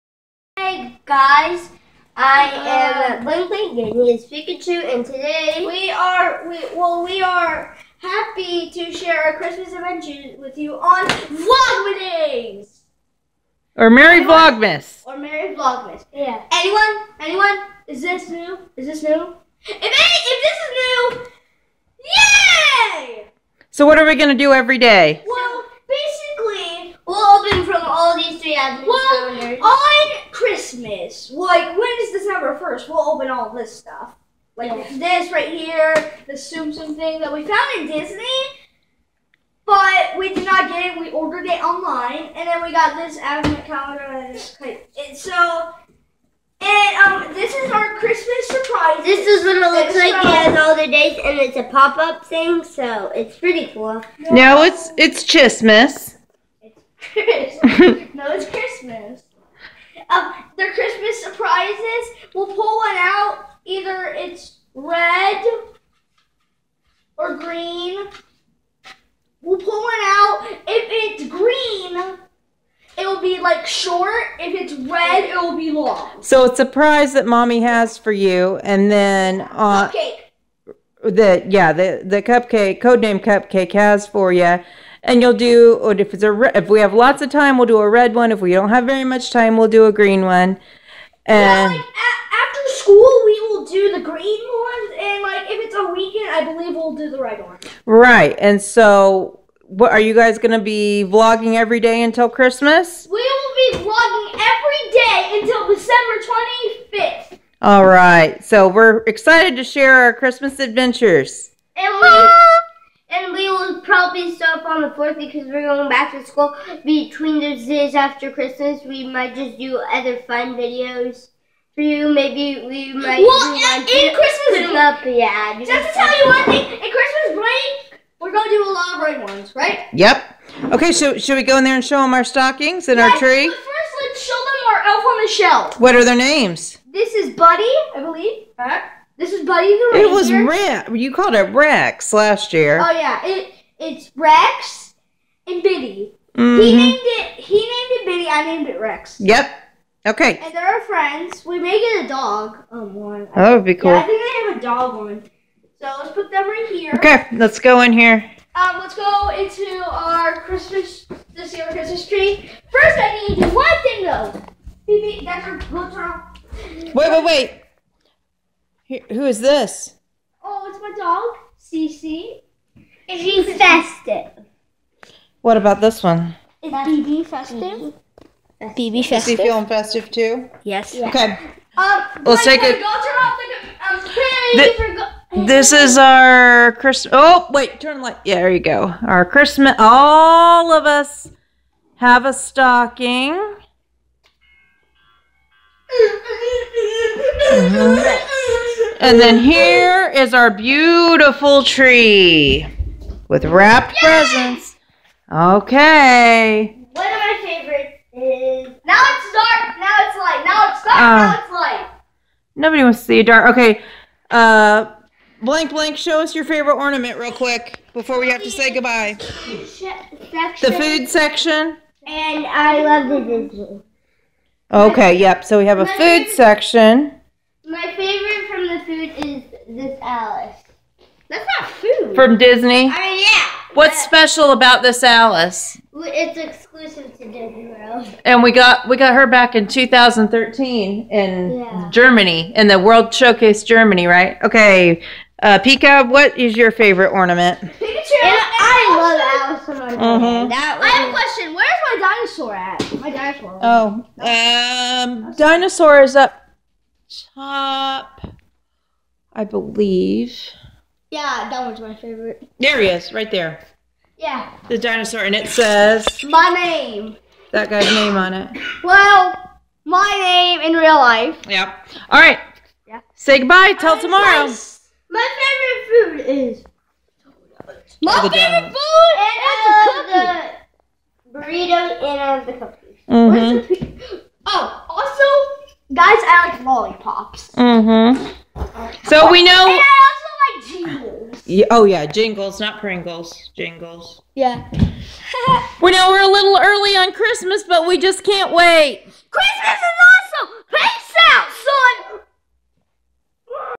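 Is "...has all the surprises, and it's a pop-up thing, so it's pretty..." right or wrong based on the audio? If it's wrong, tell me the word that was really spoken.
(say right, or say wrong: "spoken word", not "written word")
wrong: "dates", not "surprises".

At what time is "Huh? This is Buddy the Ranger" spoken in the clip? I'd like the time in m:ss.
2:18.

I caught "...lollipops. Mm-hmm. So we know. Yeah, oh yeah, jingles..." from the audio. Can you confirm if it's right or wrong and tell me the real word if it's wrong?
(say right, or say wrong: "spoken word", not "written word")
right.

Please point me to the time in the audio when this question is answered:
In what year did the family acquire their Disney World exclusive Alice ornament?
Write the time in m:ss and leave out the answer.
3:59.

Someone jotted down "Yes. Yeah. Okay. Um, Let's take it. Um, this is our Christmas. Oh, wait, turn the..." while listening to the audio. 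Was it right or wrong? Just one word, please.
right.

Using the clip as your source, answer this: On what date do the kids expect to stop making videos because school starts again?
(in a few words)
The 4th.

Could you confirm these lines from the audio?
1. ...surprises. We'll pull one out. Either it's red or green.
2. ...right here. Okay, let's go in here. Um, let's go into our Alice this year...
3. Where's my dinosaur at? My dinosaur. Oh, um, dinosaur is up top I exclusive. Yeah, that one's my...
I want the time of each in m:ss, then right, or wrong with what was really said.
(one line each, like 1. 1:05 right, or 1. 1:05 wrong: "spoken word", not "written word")
1. 1:01 right
2. 2:36 wrong: "Christmas", not "Alice"
3. 4:11 wrong: "believe", not "exclusive".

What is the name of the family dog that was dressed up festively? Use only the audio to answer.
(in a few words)
Cece.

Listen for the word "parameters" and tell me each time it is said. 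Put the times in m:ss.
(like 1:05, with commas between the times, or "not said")
not said.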